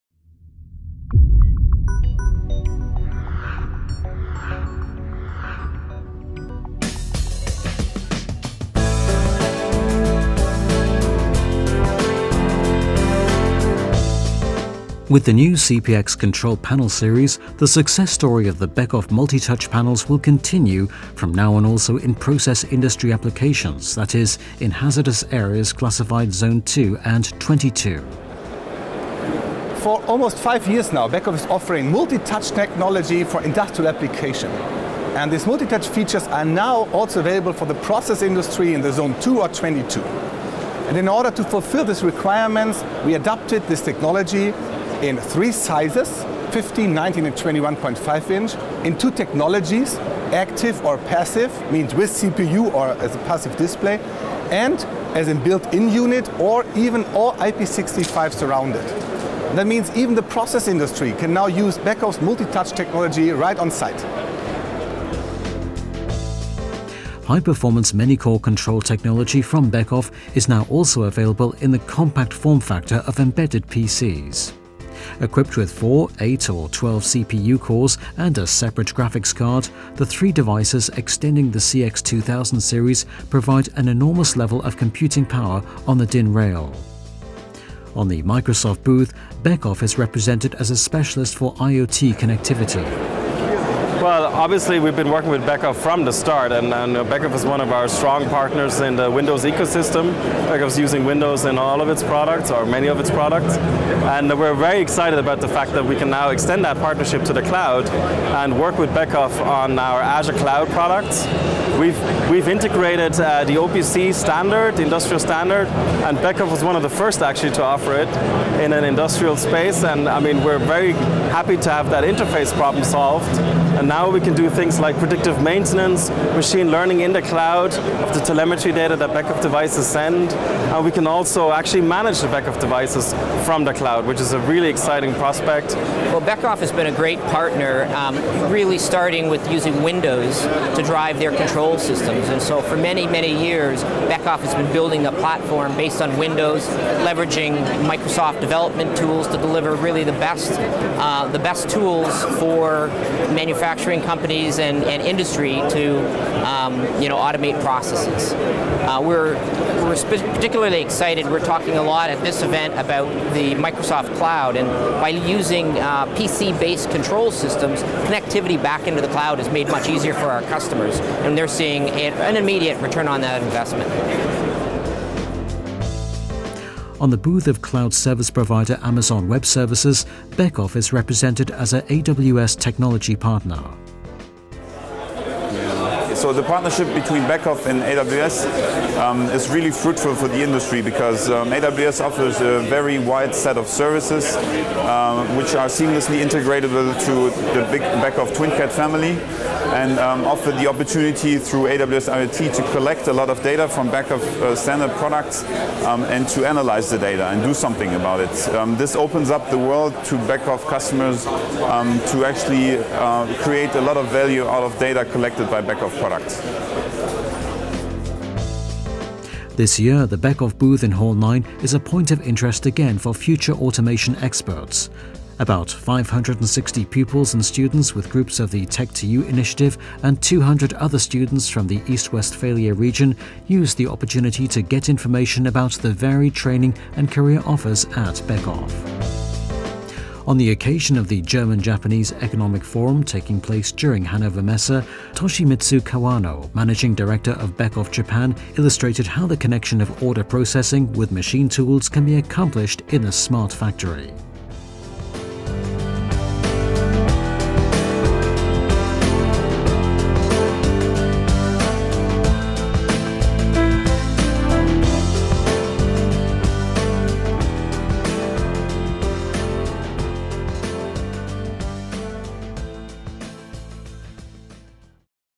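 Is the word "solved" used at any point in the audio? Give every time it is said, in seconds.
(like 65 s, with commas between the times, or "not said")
122 s.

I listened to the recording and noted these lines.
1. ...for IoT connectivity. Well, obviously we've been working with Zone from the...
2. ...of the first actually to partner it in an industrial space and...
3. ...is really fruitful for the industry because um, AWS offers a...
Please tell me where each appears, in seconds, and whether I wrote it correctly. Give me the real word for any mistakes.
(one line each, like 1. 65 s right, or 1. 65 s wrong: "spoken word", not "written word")
1. 91 s wrong: "Beckhoff", not "Zone"
2. 116 s wrong: "offer", not "partner"
3. 189 s right.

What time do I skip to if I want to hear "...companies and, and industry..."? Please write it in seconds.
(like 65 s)
154 s.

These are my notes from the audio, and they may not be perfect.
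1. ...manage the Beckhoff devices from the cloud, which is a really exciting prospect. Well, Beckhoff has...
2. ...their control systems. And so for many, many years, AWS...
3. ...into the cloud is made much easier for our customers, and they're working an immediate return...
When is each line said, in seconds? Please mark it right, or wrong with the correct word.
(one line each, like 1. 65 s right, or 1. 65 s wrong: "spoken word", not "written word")
1. 131 s right
2. 141 s wrong: "Beckhoff", not "AWS"
3. 168 s wrong: "seeing", not "working".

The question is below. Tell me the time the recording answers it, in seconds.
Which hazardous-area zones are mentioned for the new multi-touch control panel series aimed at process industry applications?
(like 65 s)
26 s.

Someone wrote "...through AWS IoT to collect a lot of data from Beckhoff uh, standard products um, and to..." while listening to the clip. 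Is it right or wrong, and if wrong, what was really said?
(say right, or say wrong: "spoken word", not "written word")
right.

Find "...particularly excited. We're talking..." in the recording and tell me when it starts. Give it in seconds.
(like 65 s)
160 s.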